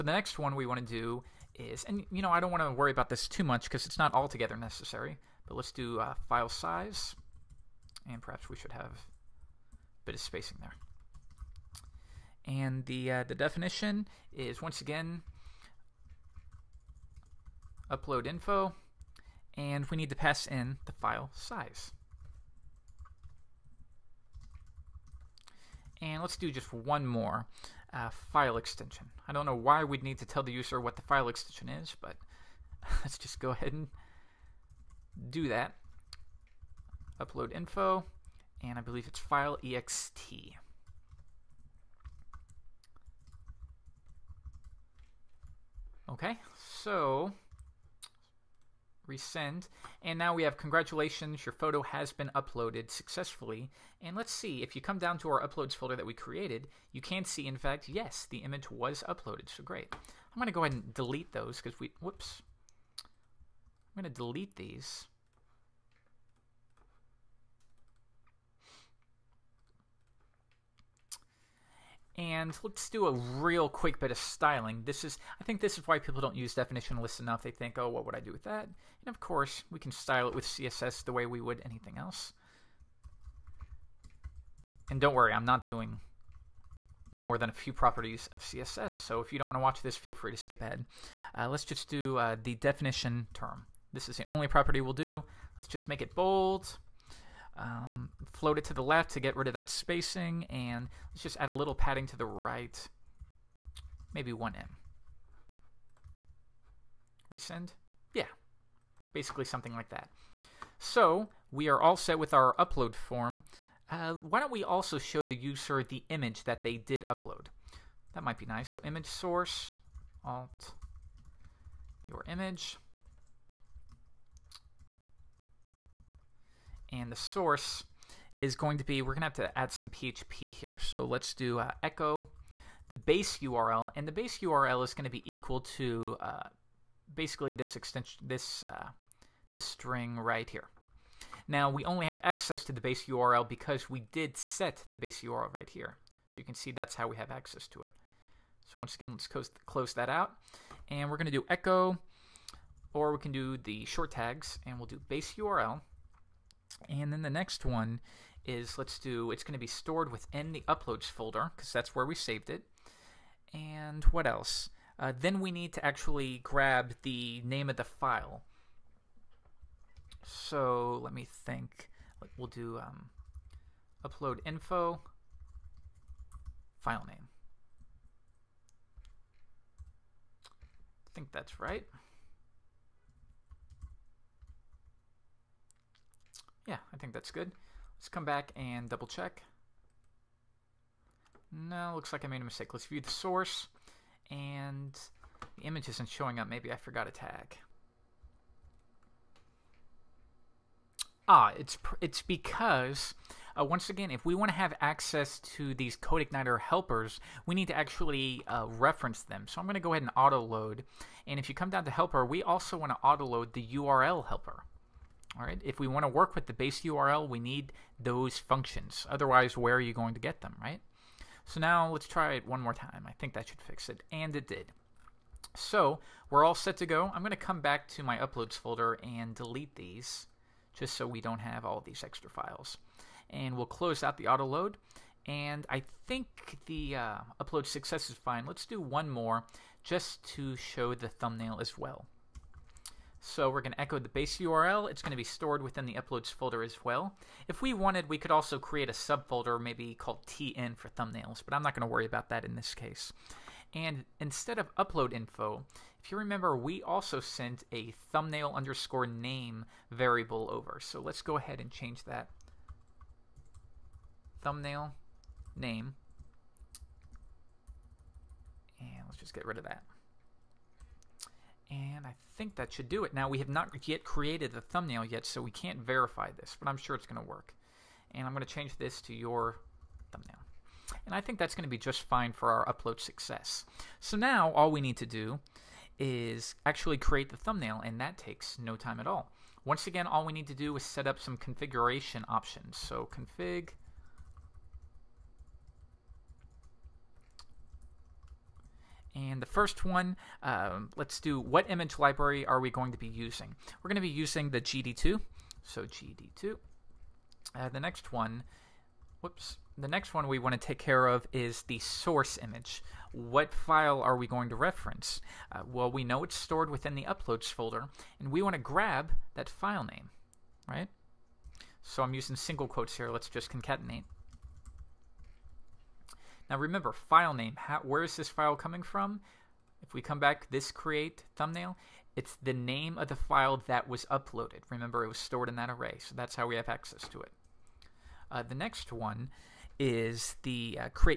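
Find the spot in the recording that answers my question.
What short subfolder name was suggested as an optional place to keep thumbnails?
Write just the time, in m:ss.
4:10.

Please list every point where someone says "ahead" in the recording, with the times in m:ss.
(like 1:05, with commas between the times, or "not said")
0:33, 1:00, 1:30, 3:29, 4:21.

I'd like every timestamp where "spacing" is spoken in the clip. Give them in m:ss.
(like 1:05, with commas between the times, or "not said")
0:10, 1:39.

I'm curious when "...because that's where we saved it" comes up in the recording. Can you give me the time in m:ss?
2:41.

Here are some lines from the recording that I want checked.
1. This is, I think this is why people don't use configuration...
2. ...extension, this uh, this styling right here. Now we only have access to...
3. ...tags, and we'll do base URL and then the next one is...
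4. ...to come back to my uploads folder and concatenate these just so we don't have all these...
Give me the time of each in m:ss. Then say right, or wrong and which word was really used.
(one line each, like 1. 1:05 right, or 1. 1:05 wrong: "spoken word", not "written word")
1. 1:14 wrong: "definition", not "configuration"
2. 2:17 wrong: "string", not "styling"
3. 2:34 right
4. 3:47 wrong: "delete", not "concatenate".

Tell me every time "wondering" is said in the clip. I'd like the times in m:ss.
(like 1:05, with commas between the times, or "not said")
not said.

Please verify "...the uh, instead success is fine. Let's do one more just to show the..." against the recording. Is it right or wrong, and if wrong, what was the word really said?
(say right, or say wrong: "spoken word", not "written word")
wrong: "upload", not "instead".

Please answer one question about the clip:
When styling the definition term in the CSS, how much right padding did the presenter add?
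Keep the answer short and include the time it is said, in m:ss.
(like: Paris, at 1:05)
1em, at 1:44.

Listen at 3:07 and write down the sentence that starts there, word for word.
Let's come back and double check.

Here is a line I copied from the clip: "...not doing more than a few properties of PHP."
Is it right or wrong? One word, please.
wrong.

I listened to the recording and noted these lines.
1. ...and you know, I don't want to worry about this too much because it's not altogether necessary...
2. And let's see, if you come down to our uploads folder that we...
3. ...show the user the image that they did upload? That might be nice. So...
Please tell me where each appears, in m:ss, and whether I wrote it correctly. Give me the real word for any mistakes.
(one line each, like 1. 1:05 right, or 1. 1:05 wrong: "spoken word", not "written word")
1. 0:01 right
2. 0:54 right
3. 1:54 right.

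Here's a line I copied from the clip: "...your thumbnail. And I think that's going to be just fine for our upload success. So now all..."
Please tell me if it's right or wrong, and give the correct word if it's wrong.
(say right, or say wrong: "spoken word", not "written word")
right.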